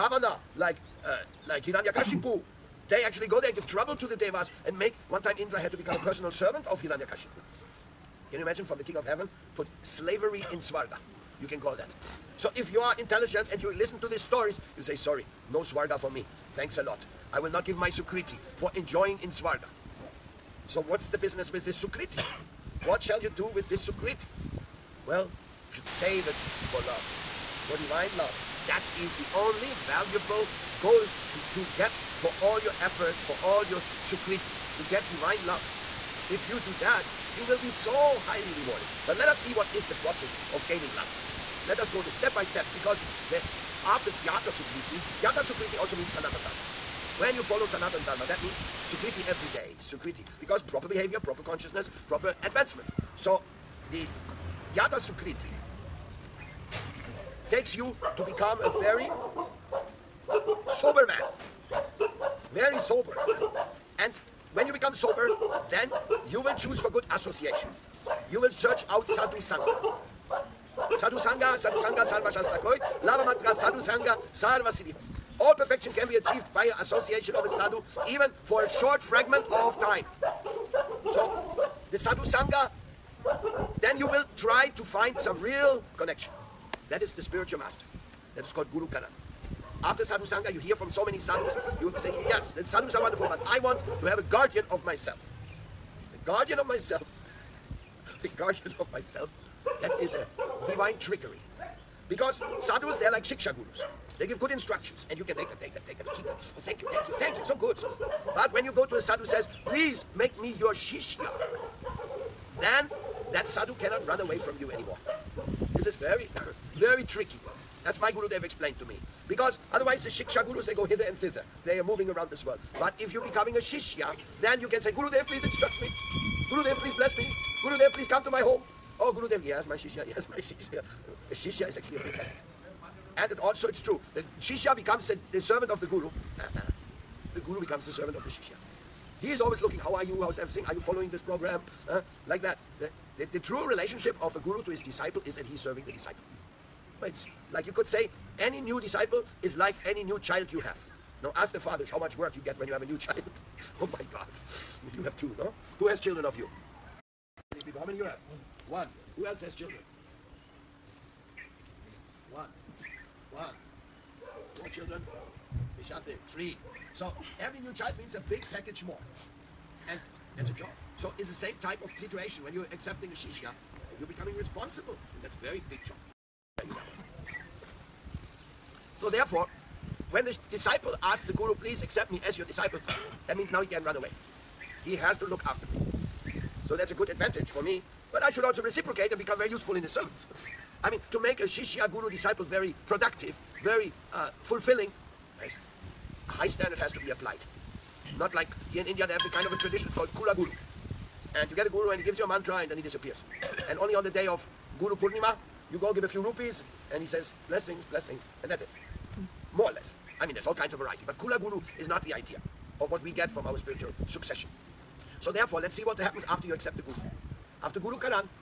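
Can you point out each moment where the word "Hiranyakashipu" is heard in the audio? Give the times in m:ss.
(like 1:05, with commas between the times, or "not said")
0:01, 0:06.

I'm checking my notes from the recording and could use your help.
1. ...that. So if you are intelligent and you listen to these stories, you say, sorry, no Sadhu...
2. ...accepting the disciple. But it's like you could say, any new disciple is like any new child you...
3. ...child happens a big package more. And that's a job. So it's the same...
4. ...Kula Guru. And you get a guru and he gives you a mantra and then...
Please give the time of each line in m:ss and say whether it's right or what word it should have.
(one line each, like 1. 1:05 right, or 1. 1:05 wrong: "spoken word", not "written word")
1. 0:11 wrong: "Swarga", not "Sadhu"
2. 2:25 wrong: "serving", not "accepting"
3. 2:47 wrong: "means", not "happens"
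4. 3:20 right.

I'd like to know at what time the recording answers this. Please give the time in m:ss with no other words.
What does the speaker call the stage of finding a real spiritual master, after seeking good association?
1:28.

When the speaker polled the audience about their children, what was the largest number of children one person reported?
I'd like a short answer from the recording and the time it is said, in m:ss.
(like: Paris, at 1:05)
4, at 2:44.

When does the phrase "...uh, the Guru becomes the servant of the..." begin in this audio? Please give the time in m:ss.
2:16.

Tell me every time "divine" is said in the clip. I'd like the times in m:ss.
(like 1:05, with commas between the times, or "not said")
0:27, 0:35, 1:40.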